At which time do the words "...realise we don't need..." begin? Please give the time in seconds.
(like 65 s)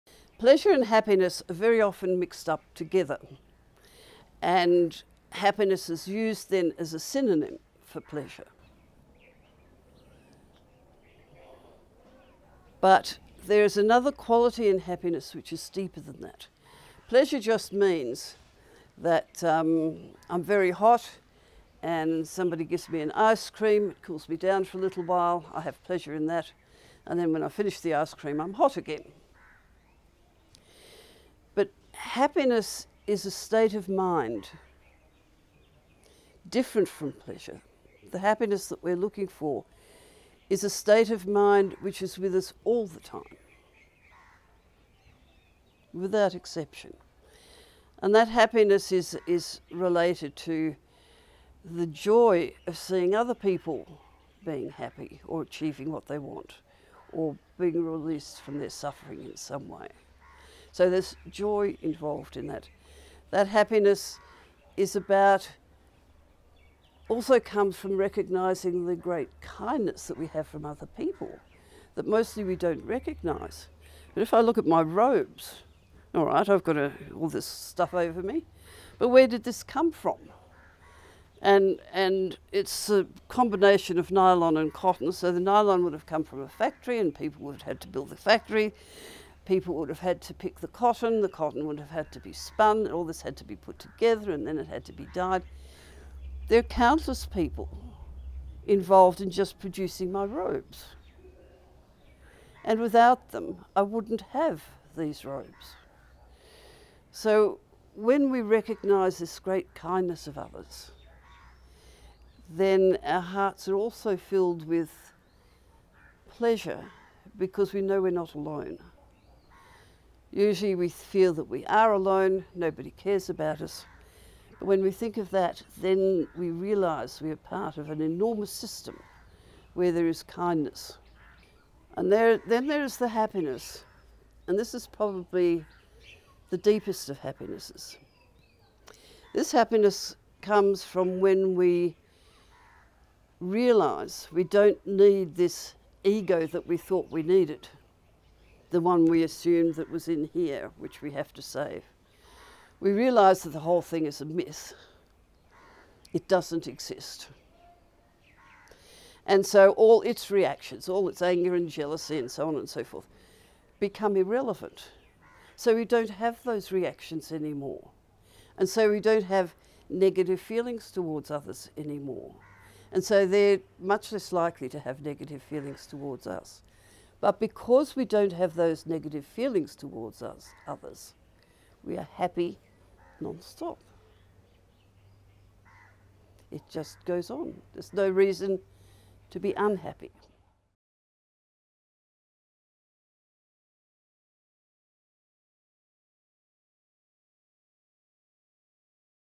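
143 s.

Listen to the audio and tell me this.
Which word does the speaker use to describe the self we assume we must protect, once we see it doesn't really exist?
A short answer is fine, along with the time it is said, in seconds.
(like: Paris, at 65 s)
myth, at 154 s.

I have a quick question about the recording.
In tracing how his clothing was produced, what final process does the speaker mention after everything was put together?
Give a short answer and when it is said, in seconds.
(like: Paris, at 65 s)
dyed, at 95 s.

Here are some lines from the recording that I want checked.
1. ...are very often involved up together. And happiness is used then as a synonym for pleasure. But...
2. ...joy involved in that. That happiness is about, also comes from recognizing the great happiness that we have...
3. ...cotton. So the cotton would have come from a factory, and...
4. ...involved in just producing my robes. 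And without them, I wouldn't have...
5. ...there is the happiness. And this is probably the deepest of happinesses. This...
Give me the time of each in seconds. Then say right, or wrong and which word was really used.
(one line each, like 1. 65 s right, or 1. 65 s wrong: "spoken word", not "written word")
1. 1 s wrong: "mixed", not "involved"
2. 61 s wrong: "kindness", not "happiness"
3. 84 s wrong: "nylon", not "cotton"
4. 98 s right
5. 132 s right.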